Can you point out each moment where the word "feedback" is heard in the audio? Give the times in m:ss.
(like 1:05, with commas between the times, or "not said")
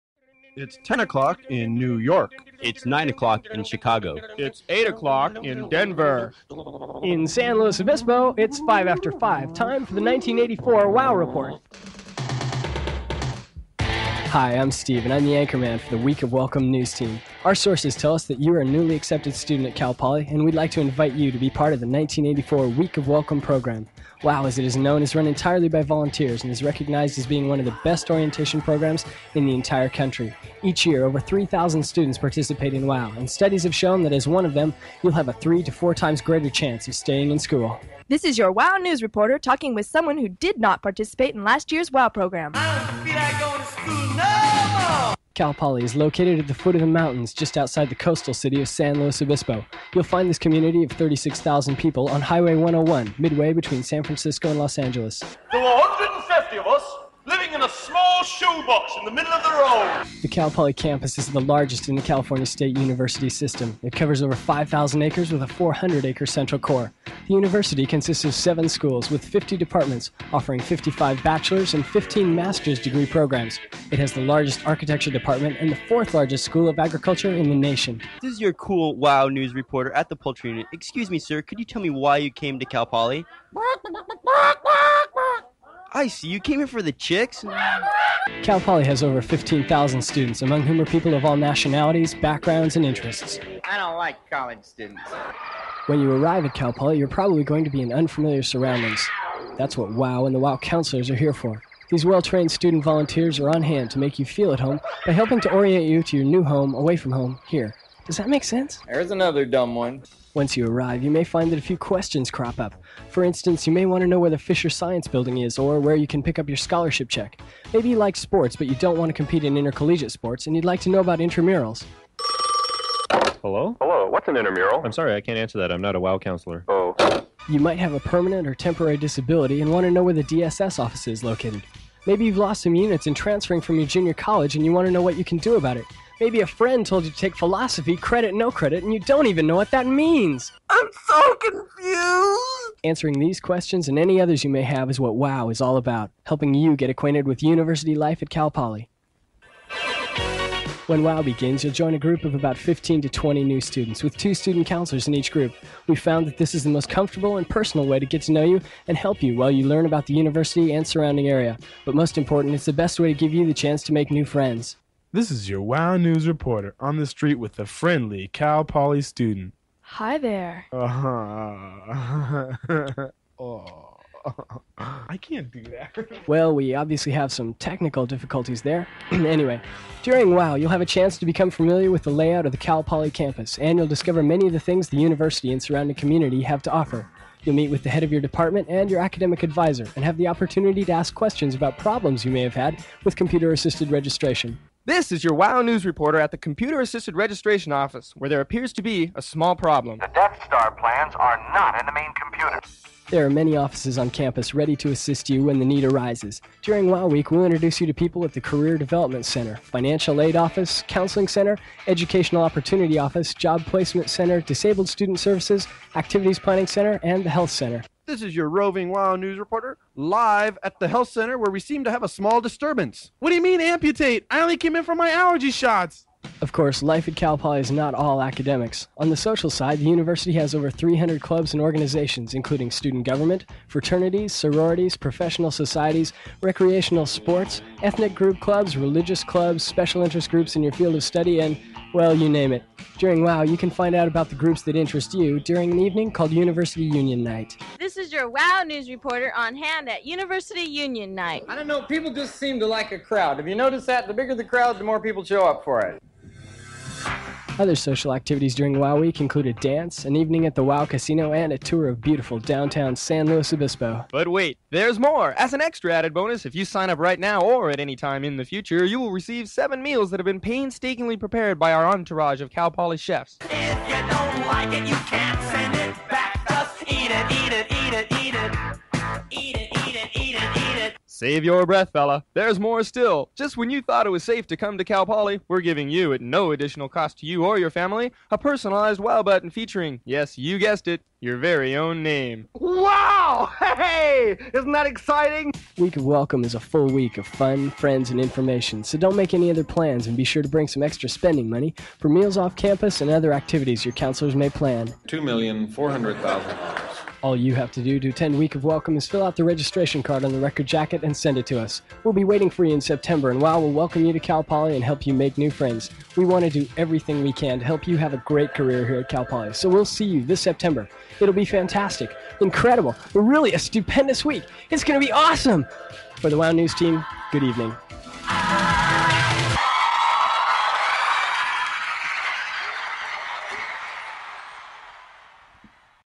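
not said.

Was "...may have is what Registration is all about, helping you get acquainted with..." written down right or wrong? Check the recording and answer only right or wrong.
wrong.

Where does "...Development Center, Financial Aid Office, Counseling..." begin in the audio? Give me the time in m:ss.
3:28.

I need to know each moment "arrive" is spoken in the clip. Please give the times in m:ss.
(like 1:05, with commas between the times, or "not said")
1:36, 1:50.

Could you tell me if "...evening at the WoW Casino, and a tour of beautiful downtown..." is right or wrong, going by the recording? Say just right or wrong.
right.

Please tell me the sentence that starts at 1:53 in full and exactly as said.
For instance, you may want to know where the Fisher Science Building is or where you can pick up your scholarship check.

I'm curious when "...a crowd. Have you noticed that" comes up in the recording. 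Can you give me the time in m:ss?
4:12.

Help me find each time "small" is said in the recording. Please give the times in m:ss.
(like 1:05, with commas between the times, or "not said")
0:57, 3:19, 3:42.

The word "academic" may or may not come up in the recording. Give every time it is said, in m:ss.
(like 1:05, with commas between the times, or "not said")
3:09, 3:48.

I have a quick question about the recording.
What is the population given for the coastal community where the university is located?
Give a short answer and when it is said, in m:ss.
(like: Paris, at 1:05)
36,000, at 0:50.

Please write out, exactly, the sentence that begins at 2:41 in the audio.
But most important, it's the best way to give you the chance to make new friends.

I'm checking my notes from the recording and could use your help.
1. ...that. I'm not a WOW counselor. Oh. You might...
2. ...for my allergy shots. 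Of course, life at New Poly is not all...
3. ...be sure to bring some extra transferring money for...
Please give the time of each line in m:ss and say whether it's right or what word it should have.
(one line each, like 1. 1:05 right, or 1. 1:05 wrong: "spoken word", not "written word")
1. 2:05 right
2. 3:44 wrong: "Cal", not "New"
3. 5:00 wrong: "spending", not "transferring".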